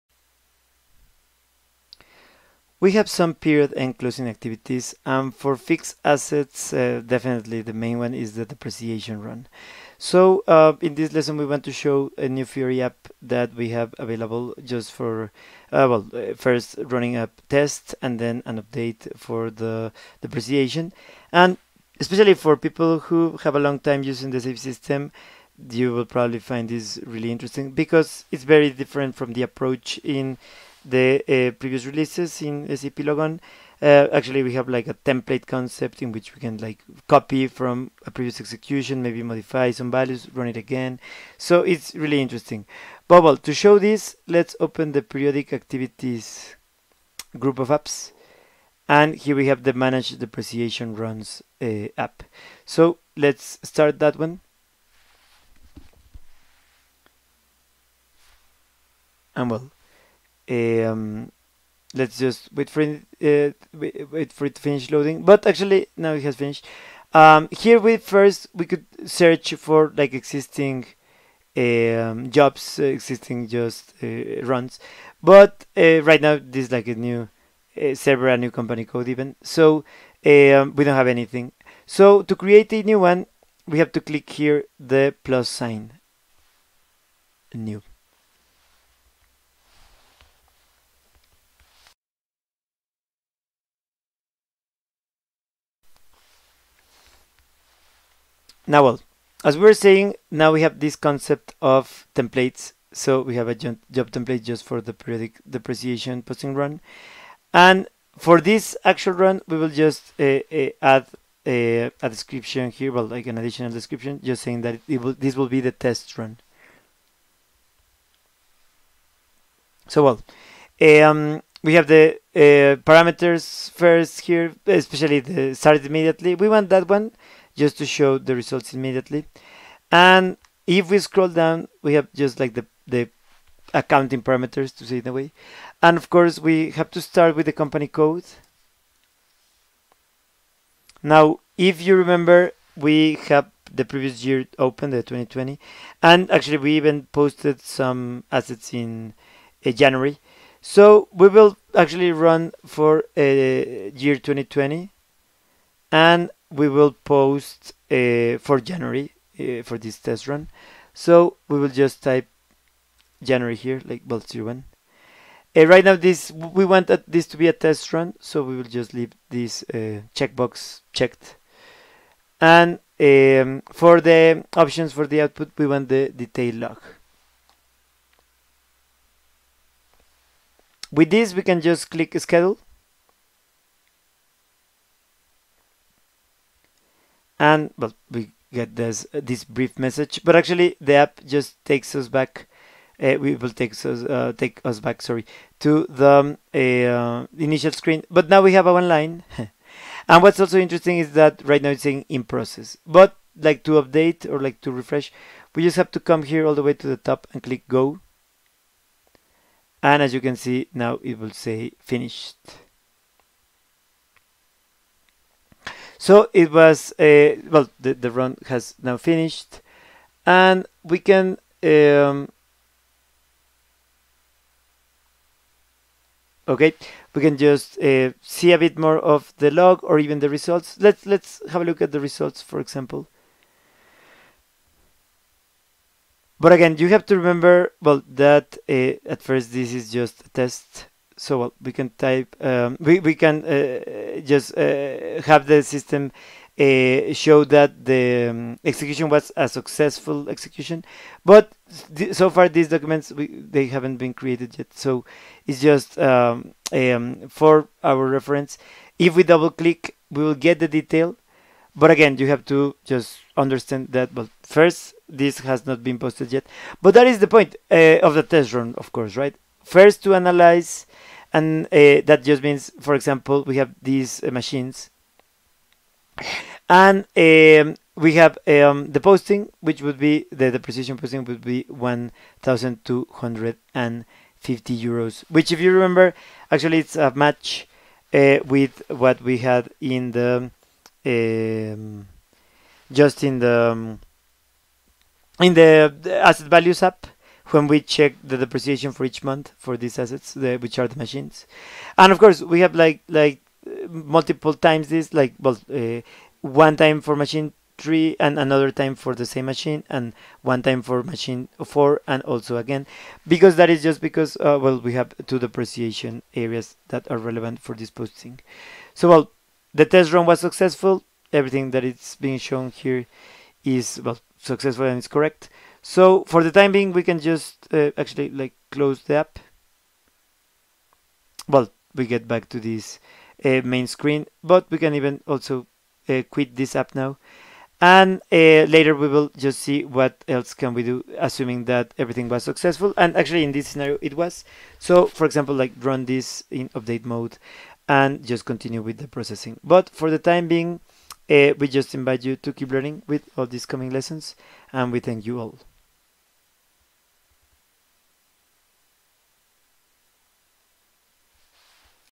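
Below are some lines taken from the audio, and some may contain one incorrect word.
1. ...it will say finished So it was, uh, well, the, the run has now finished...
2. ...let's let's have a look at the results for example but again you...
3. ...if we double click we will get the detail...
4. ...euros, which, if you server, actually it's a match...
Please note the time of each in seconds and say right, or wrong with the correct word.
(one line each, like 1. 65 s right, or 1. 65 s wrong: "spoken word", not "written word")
1. 211 s right
2. 230 s right
3. 258 s right
4. 284 s wrong: "remember", not "server".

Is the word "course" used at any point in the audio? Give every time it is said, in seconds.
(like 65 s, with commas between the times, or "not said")
136 s, 268 s, 302 s.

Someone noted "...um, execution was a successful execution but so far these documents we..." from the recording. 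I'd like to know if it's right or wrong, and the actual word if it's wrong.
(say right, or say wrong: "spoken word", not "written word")
right.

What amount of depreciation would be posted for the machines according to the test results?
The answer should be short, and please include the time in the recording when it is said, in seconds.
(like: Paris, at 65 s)
1,250 euros, at 281 s.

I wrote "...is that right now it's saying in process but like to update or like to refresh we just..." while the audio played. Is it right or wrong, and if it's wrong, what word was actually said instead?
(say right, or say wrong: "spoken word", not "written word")
right.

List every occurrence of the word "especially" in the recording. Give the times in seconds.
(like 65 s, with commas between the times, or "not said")
21 s, 124 s.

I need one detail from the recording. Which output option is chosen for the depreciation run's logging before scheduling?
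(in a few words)
detail log.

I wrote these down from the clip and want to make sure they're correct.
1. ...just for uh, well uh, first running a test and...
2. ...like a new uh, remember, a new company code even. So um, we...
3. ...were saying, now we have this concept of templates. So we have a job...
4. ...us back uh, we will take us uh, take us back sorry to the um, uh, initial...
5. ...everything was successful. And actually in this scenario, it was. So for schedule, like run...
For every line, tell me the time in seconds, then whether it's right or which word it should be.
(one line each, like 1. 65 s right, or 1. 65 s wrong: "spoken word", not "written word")
1. 14 s right
2. 76 s wrong: "server", not "remember"
3. 99 s right
4. 191 s right
5. 341 s wrong: "example", not "schedule".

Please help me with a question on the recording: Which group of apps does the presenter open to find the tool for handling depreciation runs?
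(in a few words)
periodic activities.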